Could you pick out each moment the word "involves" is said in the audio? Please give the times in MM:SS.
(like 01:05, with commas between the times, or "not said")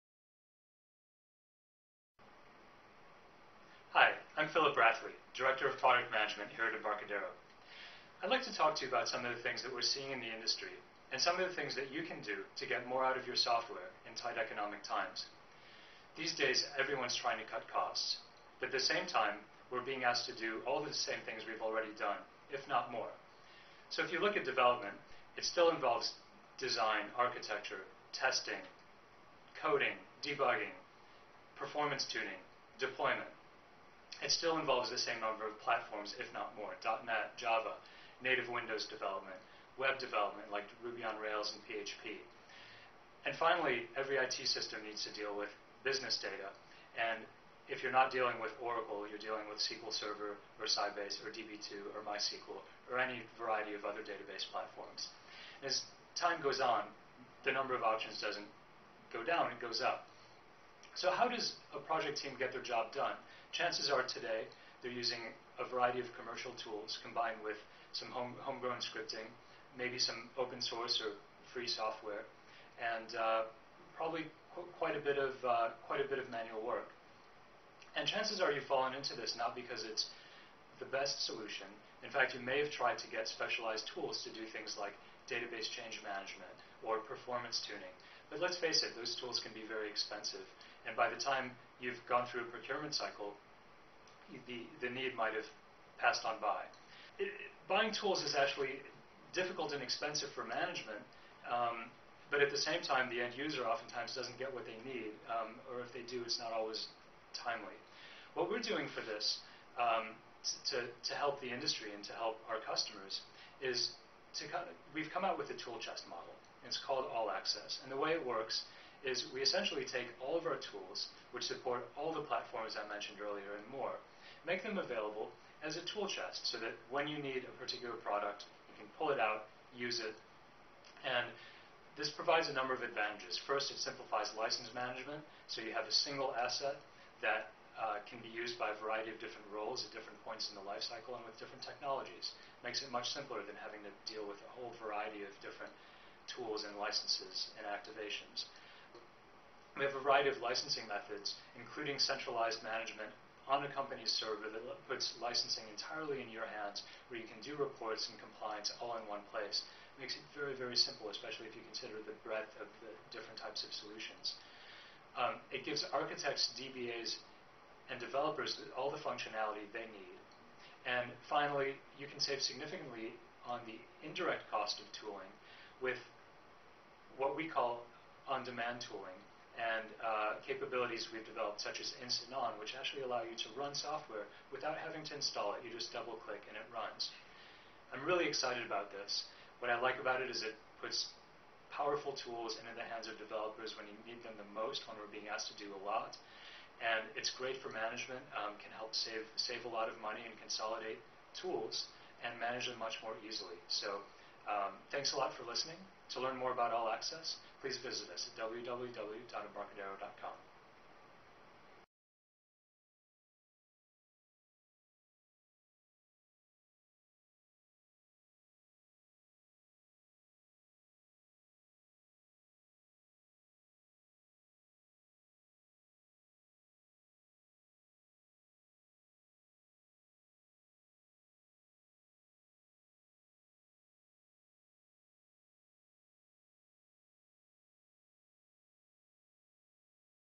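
00:25, 00:34.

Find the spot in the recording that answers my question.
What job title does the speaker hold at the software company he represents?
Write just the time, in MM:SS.
00:05.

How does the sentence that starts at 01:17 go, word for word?
And chances are you've fallen into this not because it's the best solution.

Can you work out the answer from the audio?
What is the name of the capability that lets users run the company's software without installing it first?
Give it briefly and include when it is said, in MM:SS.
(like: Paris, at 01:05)
Instant On, at 03:02.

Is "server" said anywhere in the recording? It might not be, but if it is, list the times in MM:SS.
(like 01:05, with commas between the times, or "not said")
00:49, 02:34.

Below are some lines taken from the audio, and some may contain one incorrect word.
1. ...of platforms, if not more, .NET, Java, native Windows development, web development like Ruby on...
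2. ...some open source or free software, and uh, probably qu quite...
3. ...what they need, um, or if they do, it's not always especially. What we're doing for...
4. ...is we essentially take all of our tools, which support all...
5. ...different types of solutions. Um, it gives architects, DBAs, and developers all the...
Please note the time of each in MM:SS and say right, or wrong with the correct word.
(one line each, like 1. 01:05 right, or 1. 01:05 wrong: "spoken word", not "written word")
1. 00:35 right
2. 01:09 right
3. 01:44 wrong: "timely", not "especially"
4. 01:59 right
5. 02:43 right.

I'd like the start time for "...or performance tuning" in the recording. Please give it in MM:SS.
01:26.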